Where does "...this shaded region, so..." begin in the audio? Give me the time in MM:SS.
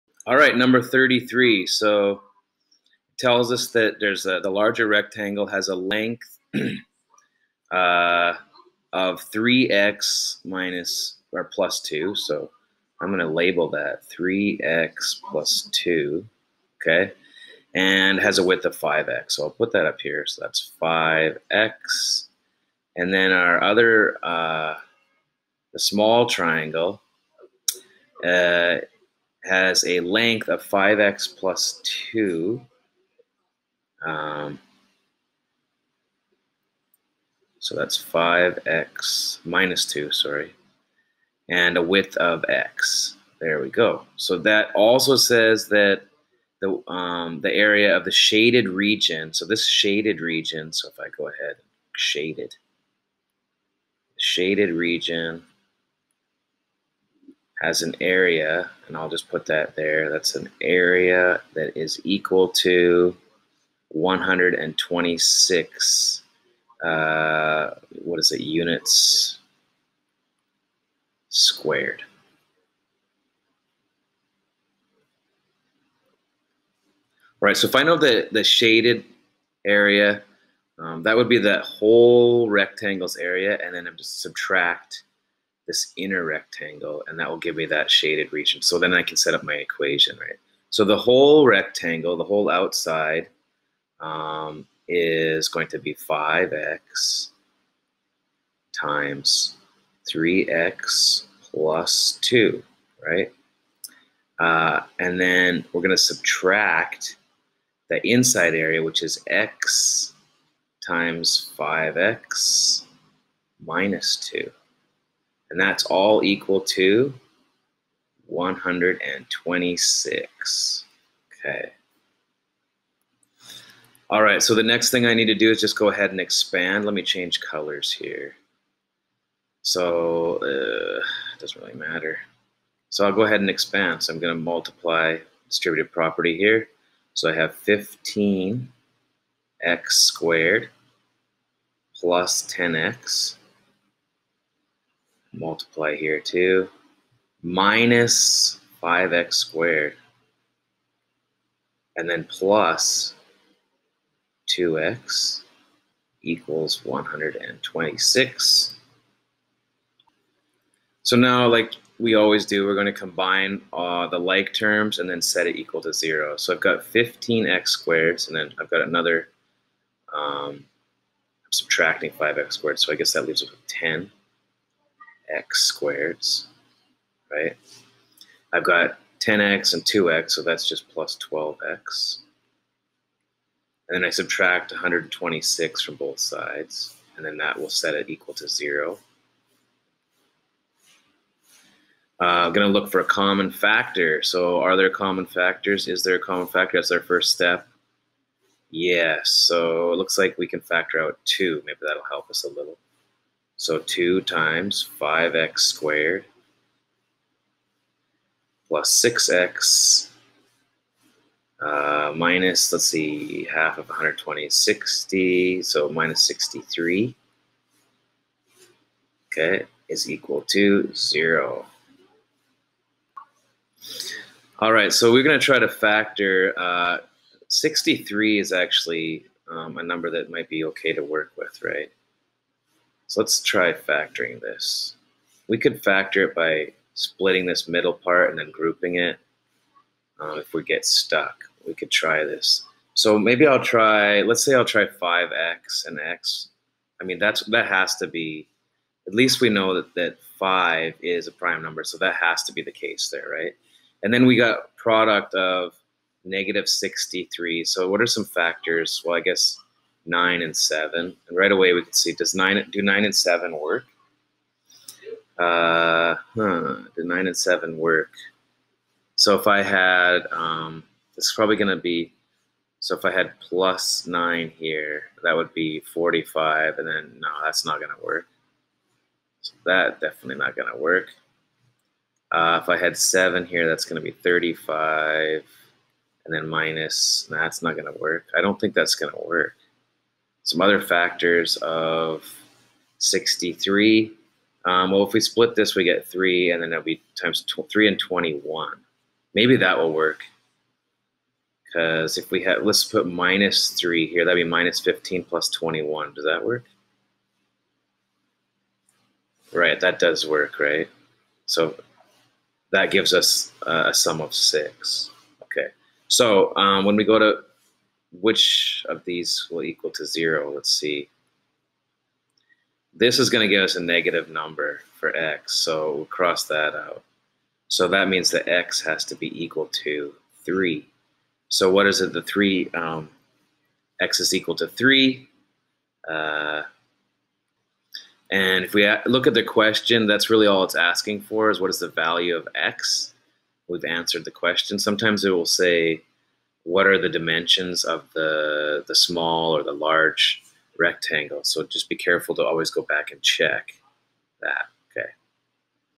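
00:49.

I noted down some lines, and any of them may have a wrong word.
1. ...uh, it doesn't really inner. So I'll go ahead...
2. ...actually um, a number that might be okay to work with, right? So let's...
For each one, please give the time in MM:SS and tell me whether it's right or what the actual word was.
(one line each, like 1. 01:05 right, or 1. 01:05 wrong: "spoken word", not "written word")
1. 02:10 wrong: "matter", not "inner"
2. 03:48 right.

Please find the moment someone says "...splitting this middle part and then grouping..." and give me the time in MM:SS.
03:56.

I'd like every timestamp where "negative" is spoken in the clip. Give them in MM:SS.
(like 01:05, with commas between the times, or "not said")
04:16, 05:23.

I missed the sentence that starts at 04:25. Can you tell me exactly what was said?
Uh, huh, do nine and seven work?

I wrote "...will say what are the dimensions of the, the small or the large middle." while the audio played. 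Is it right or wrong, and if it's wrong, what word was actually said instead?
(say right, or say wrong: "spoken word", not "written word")
wrong: "rectangle", not "middle".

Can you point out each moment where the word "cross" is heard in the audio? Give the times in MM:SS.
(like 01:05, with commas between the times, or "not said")
05:26.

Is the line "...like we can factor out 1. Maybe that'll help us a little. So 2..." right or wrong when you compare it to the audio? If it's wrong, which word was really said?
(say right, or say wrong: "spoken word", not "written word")
wrong: "2", not "1".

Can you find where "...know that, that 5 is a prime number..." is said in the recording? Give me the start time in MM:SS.
04:09.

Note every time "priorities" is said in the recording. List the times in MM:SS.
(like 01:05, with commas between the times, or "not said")
not said.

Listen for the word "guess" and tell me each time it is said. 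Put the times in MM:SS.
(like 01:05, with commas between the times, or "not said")
02:52, 04:19.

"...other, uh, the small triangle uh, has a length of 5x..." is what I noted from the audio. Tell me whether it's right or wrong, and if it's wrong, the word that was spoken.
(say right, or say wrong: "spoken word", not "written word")
right.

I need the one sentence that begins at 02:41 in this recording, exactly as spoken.
So now, like we always do, we're going to combine uh, the like terms and then set it equal to 0.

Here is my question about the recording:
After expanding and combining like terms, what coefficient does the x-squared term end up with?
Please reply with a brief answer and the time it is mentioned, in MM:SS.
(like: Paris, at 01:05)
10, at 02:53.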